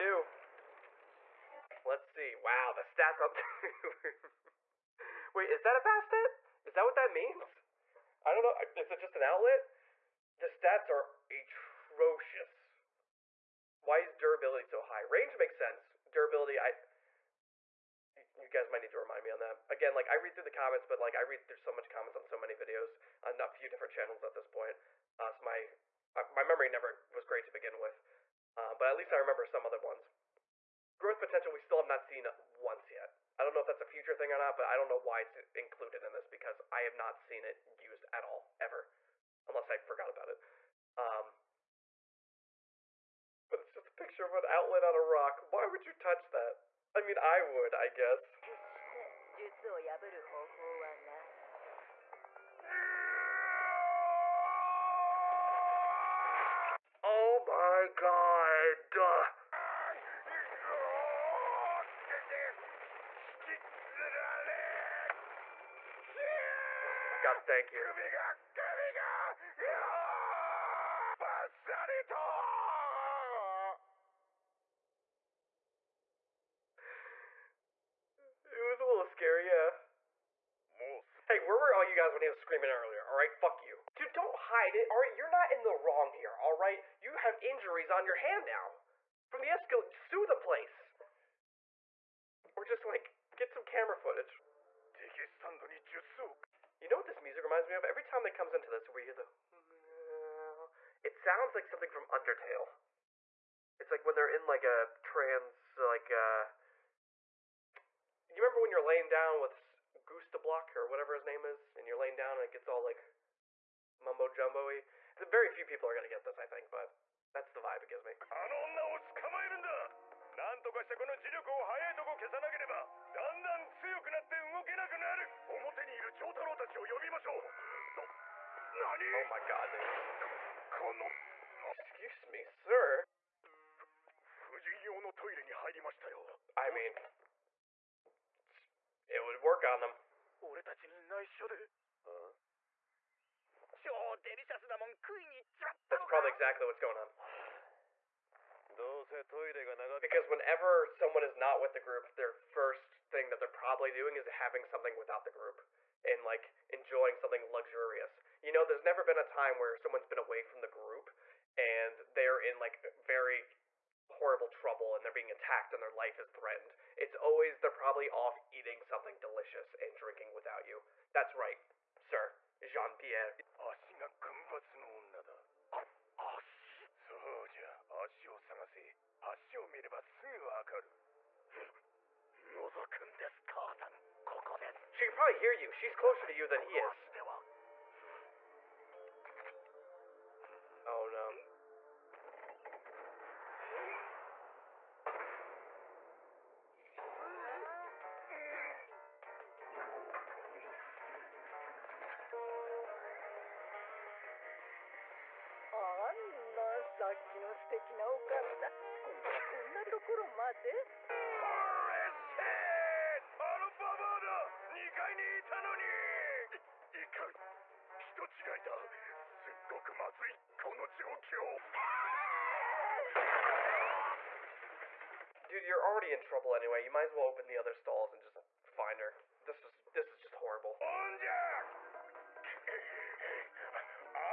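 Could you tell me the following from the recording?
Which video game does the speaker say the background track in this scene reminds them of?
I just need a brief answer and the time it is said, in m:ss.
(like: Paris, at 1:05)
Undertale, at 1:42.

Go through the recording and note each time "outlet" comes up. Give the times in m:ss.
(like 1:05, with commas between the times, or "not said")
0:09, 0:44.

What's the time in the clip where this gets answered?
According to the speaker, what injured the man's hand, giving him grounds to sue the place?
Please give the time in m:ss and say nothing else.
1:29.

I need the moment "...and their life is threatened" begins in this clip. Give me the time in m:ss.
2:45.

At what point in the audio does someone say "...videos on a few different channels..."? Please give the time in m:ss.
0:22.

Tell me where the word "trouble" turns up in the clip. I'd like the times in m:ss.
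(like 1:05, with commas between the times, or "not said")
2:44, 3:46.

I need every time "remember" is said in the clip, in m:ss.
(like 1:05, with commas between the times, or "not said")
0:29, 1:48.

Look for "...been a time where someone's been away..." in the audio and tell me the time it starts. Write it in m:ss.
2:39.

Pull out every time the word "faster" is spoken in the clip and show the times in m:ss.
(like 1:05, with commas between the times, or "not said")
not said.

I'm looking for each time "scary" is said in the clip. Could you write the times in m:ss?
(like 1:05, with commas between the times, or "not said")
1:19.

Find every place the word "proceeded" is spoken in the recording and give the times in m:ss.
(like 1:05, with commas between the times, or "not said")
not said.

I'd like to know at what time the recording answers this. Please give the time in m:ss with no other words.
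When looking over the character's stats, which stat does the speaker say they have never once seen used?
0:30.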